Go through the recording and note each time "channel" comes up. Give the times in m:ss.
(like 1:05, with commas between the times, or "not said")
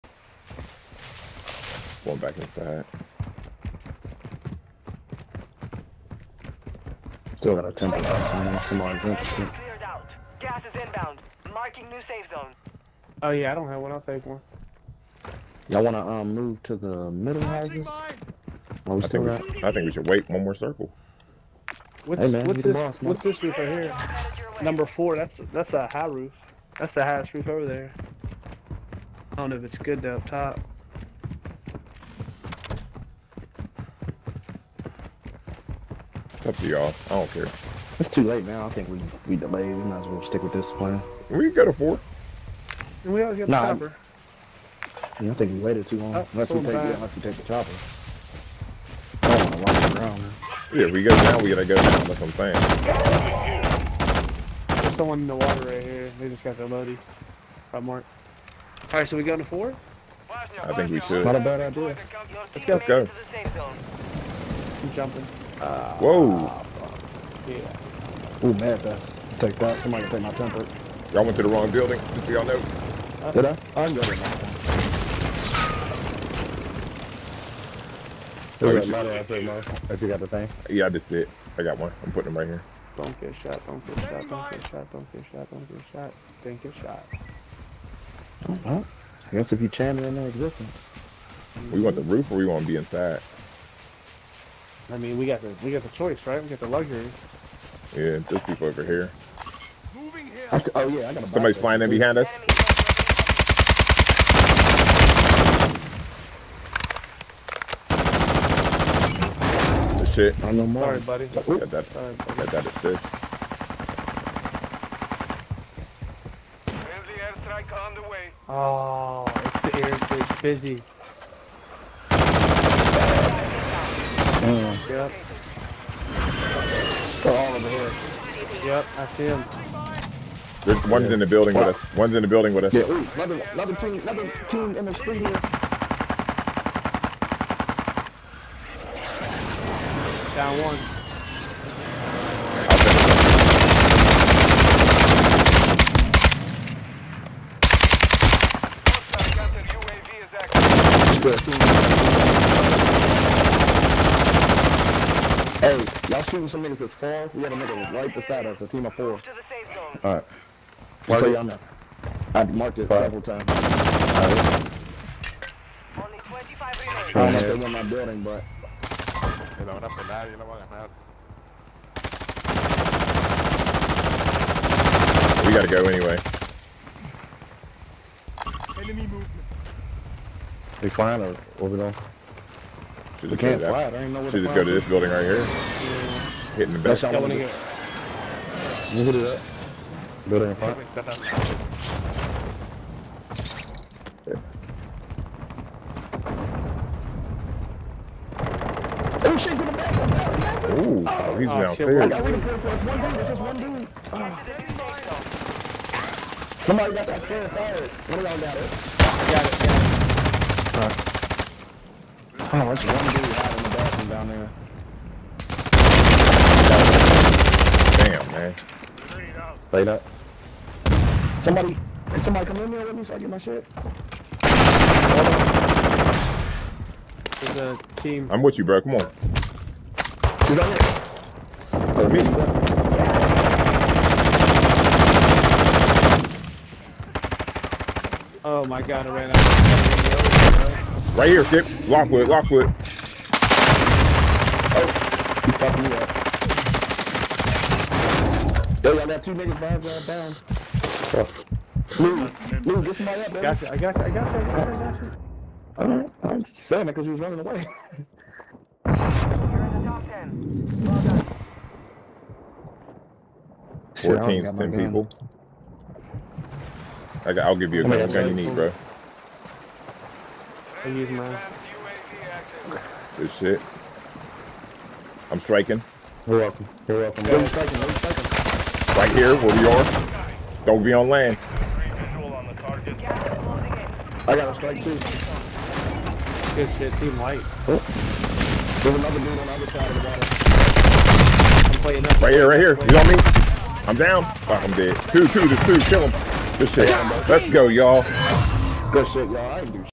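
1:29.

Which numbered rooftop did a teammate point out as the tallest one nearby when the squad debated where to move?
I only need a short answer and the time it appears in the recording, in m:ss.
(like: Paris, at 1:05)
Number four, at 0:24.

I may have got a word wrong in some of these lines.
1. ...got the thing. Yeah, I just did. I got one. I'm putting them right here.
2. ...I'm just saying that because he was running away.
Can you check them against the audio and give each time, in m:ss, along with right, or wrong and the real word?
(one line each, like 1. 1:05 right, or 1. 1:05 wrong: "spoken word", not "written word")
1. 1:20 right
2. 4:16 right.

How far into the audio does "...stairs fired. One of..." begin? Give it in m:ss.
3:27.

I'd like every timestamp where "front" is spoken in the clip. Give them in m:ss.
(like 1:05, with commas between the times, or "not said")
3:10.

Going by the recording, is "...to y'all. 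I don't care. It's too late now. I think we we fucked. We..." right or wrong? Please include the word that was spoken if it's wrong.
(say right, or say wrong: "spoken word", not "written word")
wrong: "delayed", not "fucked".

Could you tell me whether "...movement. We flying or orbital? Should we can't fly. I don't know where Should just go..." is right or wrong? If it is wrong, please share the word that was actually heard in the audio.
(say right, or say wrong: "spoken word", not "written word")
right.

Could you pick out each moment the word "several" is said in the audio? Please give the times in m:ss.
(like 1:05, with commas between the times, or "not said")
2:43.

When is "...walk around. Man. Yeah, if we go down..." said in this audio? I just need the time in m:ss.
0:49.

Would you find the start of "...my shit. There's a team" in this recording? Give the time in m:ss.
3:43.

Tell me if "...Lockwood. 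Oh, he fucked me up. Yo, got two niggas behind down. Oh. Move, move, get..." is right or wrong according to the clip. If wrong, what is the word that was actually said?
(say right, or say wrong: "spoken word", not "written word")
right.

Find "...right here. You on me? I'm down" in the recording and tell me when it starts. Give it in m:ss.
4:52.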